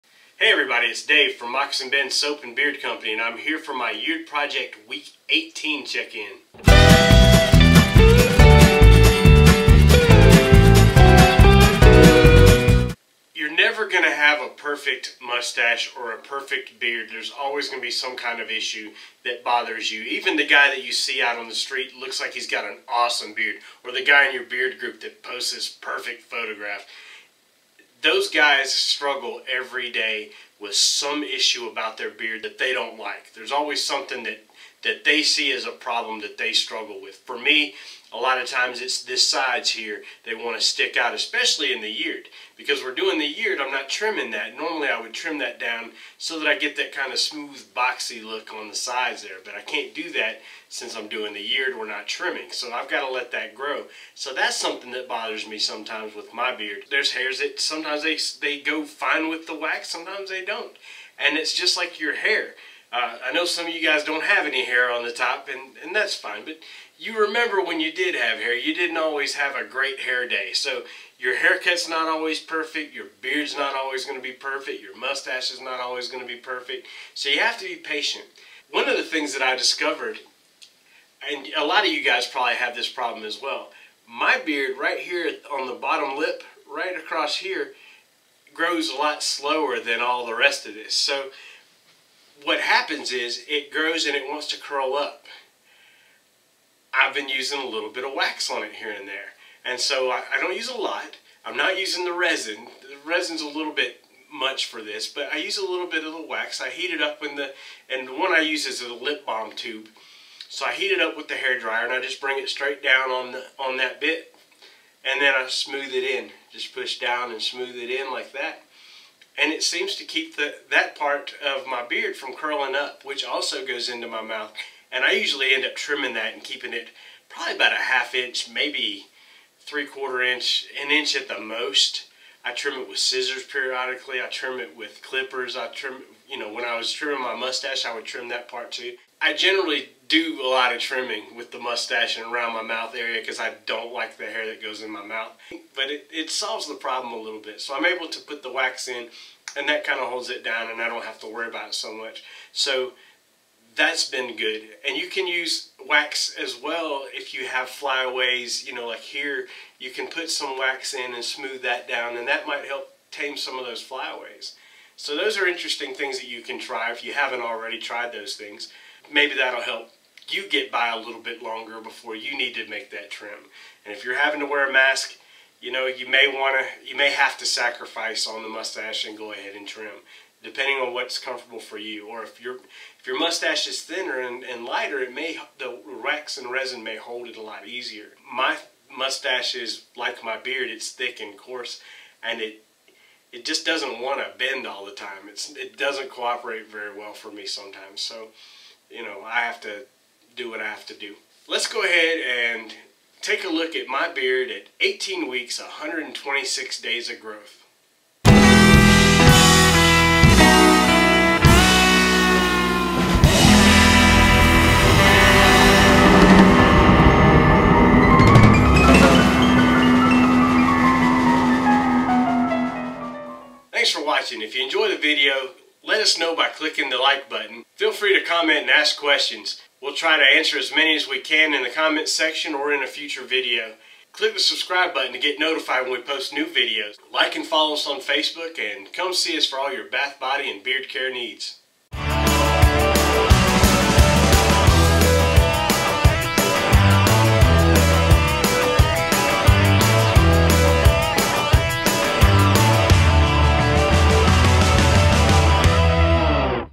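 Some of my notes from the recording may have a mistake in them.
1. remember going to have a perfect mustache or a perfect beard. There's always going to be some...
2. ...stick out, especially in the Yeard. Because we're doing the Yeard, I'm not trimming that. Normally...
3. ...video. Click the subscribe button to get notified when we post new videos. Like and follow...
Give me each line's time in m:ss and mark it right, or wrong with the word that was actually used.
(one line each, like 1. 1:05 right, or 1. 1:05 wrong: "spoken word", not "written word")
1. 0:13 wrong: "never", not "remember"
2. 0:40 right
3. 3:53 right.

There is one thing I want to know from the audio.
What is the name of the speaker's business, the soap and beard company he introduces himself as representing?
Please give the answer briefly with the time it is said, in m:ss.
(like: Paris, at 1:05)
Moccasin Bend Soap and Beard Company, at 0:01.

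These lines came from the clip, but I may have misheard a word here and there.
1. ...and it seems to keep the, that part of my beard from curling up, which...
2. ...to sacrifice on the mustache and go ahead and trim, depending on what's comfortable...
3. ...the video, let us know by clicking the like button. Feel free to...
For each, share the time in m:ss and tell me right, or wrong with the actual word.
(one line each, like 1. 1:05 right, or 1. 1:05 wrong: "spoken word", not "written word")
1. 1:59 right
2. 2:57 right
3. 3:44 right.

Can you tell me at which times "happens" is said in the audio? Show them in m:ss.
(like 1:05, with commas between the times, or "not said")
1:32.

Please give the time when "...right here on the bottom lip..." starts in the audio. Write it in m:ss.
1:24.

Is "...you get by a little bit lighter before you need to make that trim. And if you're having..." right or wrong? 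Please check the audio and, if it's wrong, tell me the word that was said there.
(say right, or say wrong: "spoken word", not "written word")
wrong: "longer", not "lighter".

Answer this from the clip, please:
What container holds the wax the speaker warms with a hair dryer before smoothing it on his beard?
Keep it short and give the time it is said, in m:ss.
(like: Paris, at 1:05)
lip balm tube, at 1:48.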